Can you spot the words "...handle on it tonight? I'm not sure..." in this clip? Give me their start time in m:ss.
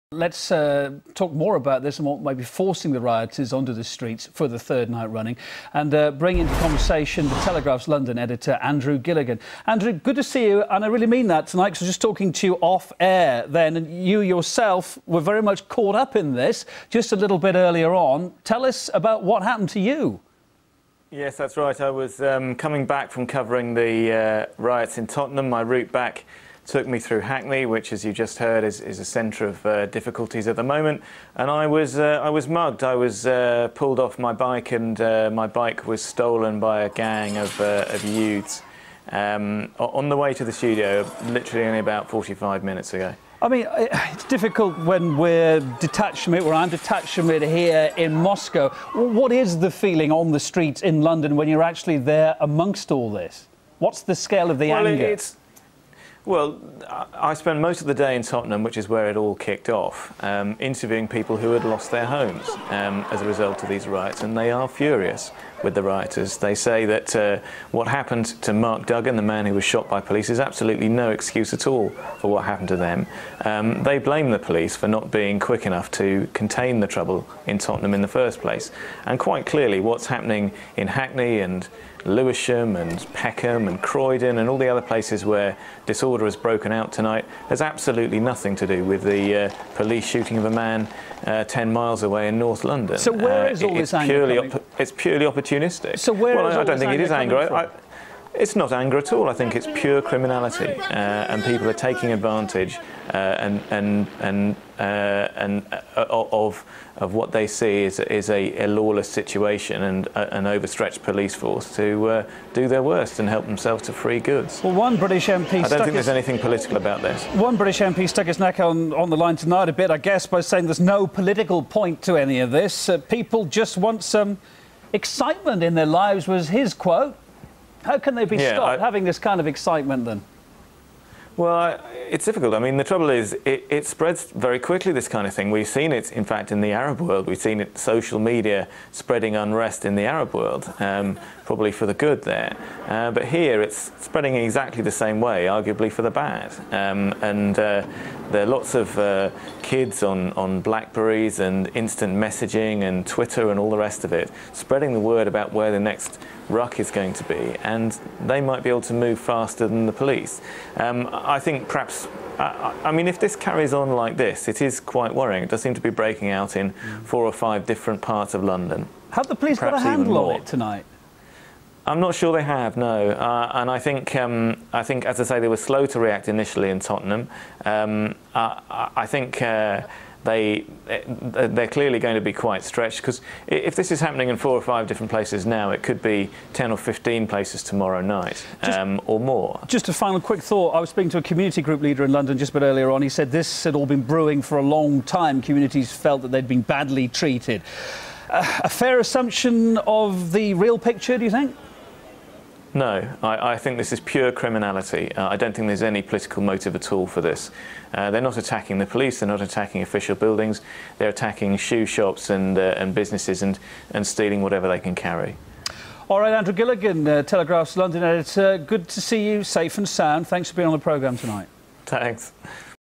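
2:49.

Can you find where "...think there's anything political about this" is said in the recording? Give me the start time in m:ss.
1:55.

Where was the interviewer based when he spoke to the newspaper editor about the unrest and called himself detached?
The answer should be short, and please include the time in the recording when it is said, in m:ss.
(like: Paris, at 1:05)
Moscow, at 0:48.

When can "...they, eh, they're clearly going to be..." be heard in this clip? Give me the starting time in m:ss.
3:00.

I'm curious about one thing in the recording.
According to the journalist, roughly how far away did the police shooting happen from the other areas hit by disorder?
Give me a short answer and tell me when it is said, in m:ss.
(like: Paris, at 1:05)
10 miles, at 1:31.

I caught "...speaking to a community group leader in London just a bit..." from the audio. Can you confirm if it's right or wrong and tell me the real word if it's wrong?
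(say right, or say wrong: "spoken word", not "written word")
right.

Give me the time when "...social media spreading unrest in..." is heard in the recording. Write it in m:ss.
2:17.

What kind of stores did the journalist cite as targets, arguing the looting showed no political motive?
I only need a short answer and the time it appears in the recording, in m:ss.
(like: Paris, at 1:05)
Shoe shops, at 3:31.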